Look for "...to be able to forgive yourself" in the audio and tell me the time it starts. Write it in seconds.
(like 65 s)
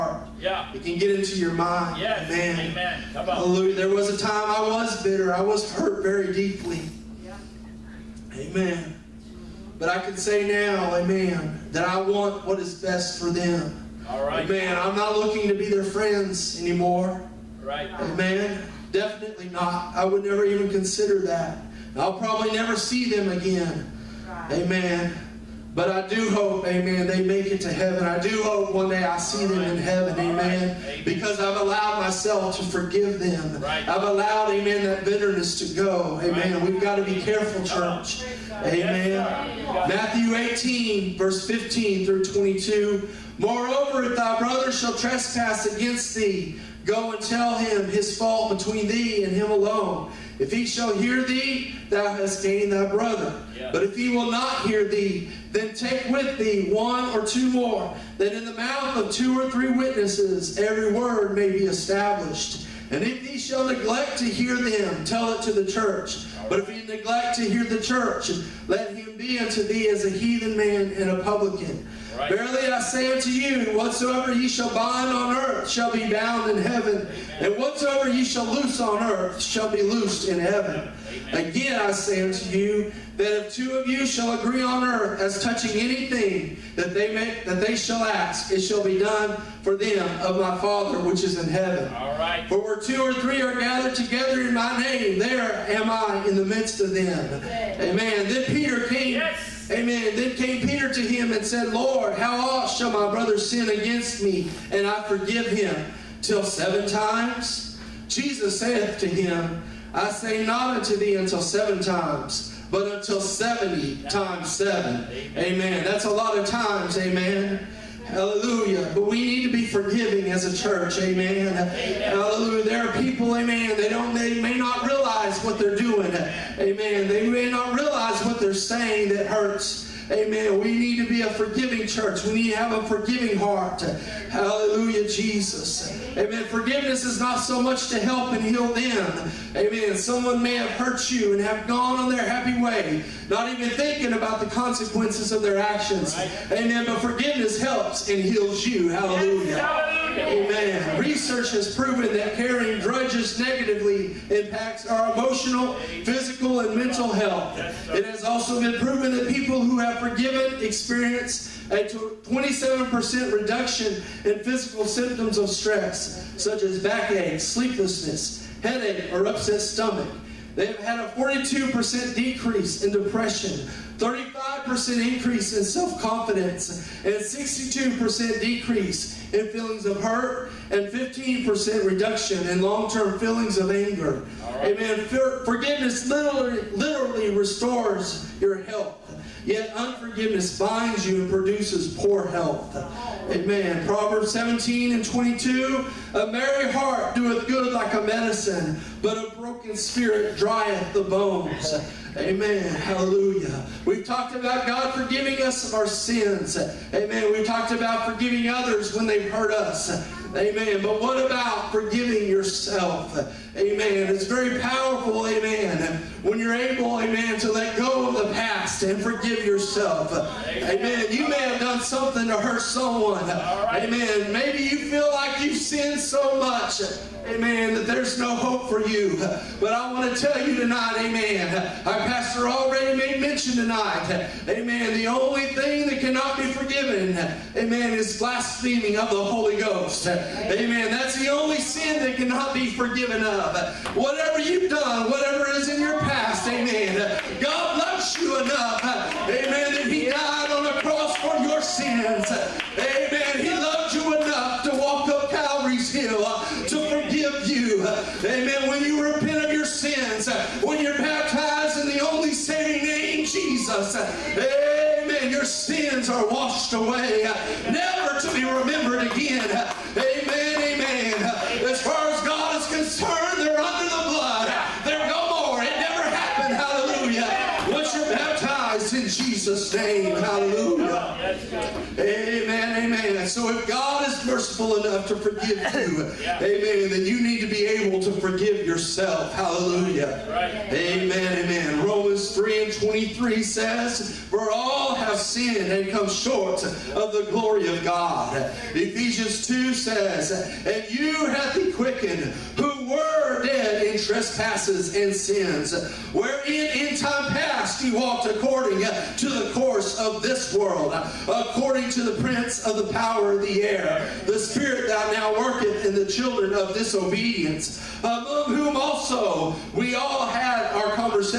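287 s.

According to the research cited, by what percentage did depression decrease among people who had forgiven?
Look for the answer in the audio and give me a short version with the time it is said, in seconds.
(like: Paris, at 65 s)
42%, at 171 s.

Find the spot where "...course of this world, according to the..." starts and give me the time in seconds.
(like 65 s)
309 s.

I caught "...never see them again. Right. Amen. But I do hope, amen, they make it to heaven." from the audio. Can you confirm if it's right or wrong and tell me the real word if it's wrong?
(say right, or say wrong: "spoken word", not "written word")
right.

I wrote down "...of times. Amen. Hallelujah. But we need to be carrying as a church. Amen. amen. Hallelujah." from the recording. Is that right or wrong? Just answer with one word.
wrong.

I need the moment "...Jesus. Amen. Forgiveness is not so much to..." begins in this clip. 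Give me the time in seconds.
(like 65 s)
135 s.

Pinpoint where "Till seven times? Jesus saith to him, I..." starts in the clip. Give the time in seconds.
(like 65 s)
106 s.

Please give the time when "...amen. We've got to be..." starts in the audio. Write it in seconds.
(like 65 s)
36 s.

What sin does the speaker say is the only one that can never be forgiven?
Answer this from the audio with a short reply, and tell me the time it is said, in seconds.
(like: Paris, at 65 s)
blaspheming of the Holy Ghost, at 238 s.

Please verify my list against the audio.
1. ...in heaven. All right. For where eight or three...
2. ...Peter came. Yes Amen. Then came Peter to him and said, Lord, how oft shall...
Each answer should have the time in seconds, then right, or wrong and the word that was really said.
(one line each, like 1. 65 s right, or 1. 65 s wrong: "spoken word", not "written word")
1. 91 s wrong: "two", not "eight"
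2. 98 s right.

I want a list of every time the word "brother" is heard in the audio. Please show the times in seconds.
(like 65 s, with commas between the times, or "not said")
44 s, 52 s, 103 s.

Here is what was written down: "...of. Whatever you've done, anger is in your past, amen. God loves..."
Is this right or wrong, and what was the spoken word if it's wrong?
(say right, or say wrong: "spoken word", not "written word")
wrong: "whatever", not "anger".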